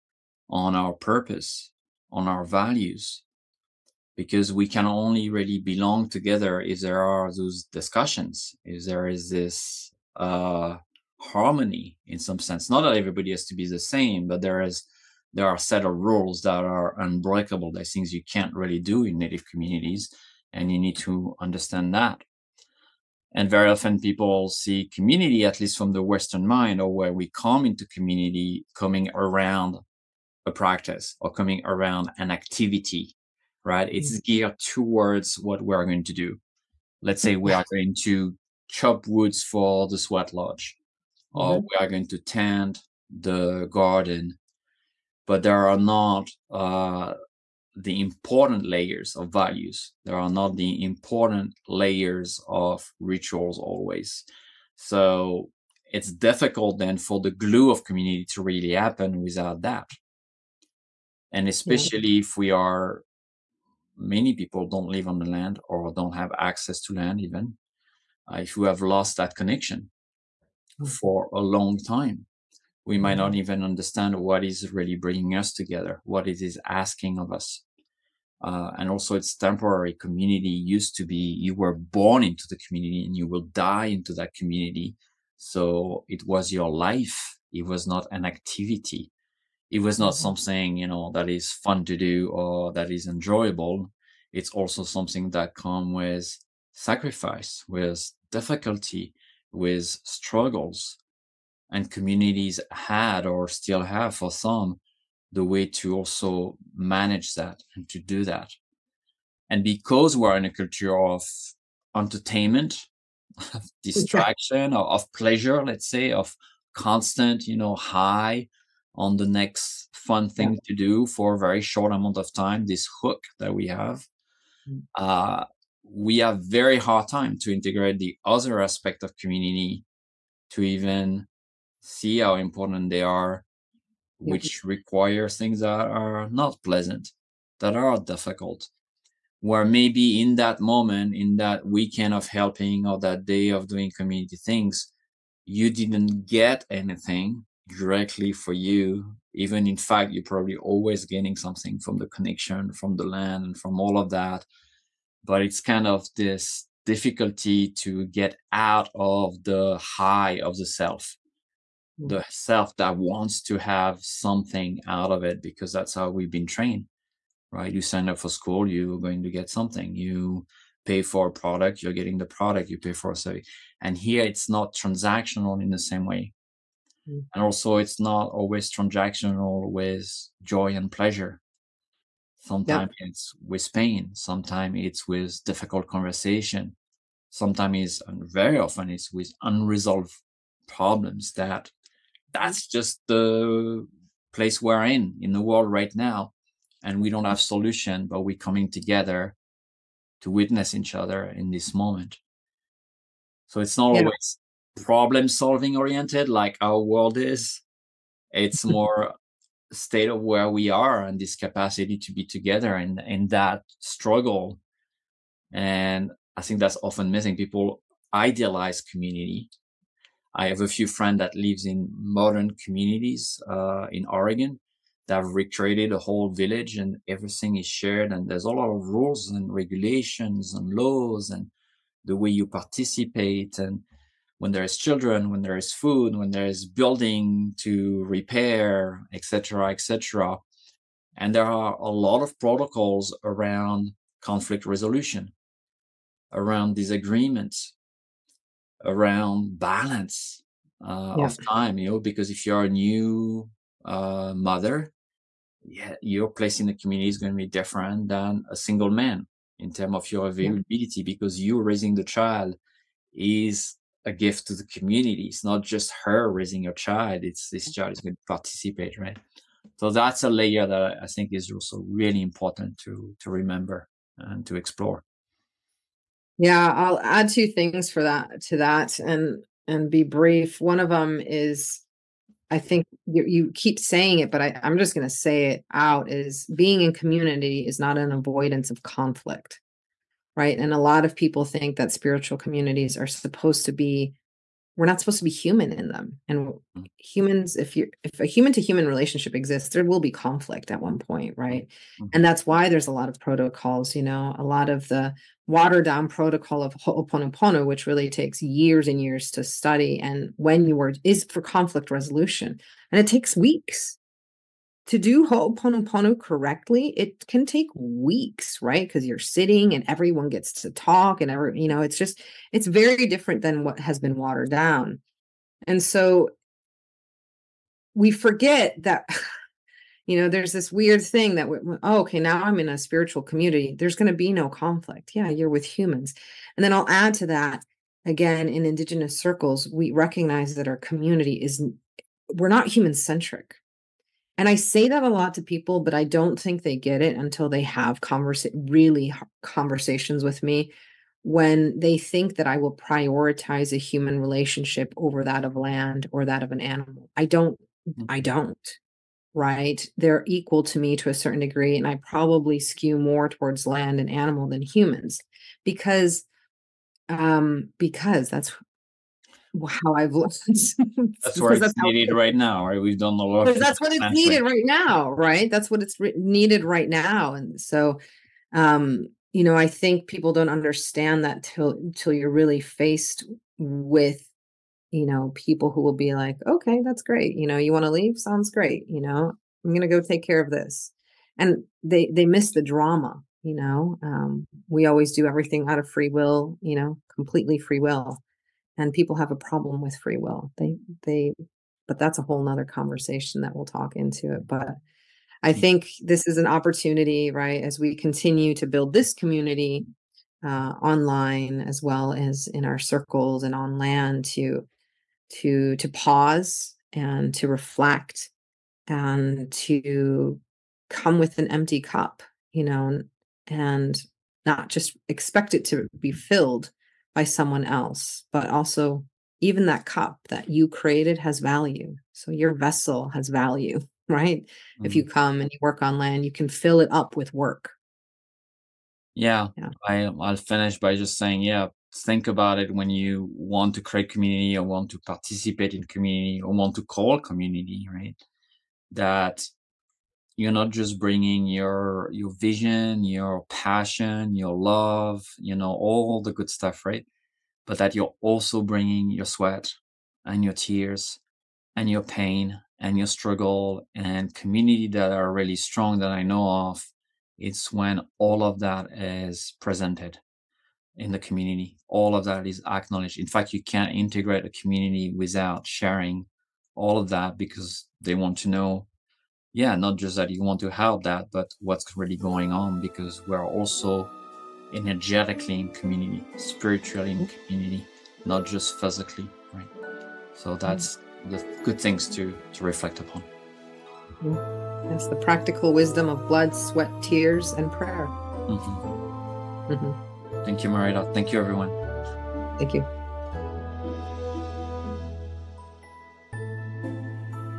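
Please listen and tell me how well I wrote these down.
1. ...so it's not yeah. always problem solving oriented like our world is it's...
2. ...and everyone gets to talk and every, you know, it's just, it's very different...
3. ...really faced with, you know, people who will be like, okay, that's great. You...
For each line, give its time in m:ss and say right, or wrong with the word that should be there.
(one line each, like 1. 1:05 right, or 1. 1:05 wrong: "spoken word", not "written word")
1. 3:23 right
2. 5:19 right
3. 6:22 right.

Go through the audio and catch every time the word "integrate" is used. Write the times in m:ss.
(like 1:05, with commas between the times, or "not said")
2:07, 7:53.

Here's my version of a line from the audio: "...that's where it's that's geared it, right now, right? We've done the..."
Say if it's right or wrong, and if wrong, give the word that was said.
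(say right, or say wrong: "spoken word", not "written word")
wrong: "needed", not "geared".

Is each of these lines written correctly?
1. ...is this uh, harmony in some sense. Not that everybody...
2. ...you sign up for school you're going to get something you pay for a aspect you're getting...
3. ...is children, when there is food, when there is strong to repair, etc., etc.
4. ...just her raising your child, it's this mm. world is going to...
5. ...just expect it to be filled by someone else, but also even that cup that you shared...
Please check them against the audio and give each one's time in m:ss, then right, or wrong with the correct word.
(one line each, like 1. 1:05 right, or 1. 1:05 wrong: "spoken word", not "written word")
1. 0:09 right
2. 2:47 wrong: "product", not "aspect"
3. 3:54 wrong: "building", not "strong"
4. 4:25 wrong: "child", not "world"
5. 7:04 wrong: "created", not "shared".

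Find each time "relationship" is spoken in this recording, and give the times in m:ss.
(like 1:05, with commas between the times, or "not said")
4:58, 5:54.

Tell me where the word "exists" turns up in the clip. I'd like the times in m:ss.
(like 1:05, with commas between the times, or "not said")
4:59.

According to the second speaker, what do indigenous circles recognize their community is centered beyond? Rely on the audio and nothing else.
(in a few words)
human centric.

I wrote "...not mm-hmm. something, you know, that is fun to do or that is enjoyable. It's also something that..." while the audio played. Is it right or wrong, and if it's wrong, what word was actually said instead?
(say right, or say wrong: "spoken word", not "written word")
right.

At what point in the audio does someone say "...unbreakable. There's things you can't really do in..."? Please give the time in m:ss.
0:16.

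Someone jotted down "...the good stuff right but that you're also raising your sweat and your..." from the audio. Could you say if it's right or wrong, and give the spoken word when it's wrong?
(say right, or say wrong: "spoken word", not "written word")
wrong: "bringing", not "raising".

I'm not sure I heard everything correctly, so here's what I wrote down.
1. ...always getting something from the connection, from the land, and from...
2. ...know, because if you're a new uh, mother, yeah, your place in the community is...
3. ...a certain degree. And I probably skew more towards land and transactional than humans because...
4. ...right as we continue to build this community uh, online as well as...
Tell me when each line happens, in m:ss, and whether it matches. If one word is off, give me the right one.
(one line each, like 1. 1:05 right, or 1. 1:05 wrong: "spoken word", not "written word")
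1. 2:30 right
2. 4:11 right
3. 6:01 wrong: "animal", not "transactional"
4. 6:47 right.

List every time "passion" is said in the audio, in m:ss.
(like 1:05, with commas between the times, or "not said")
7:33.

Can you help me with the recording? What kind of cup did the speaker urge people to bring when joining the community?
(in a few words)
empty cup.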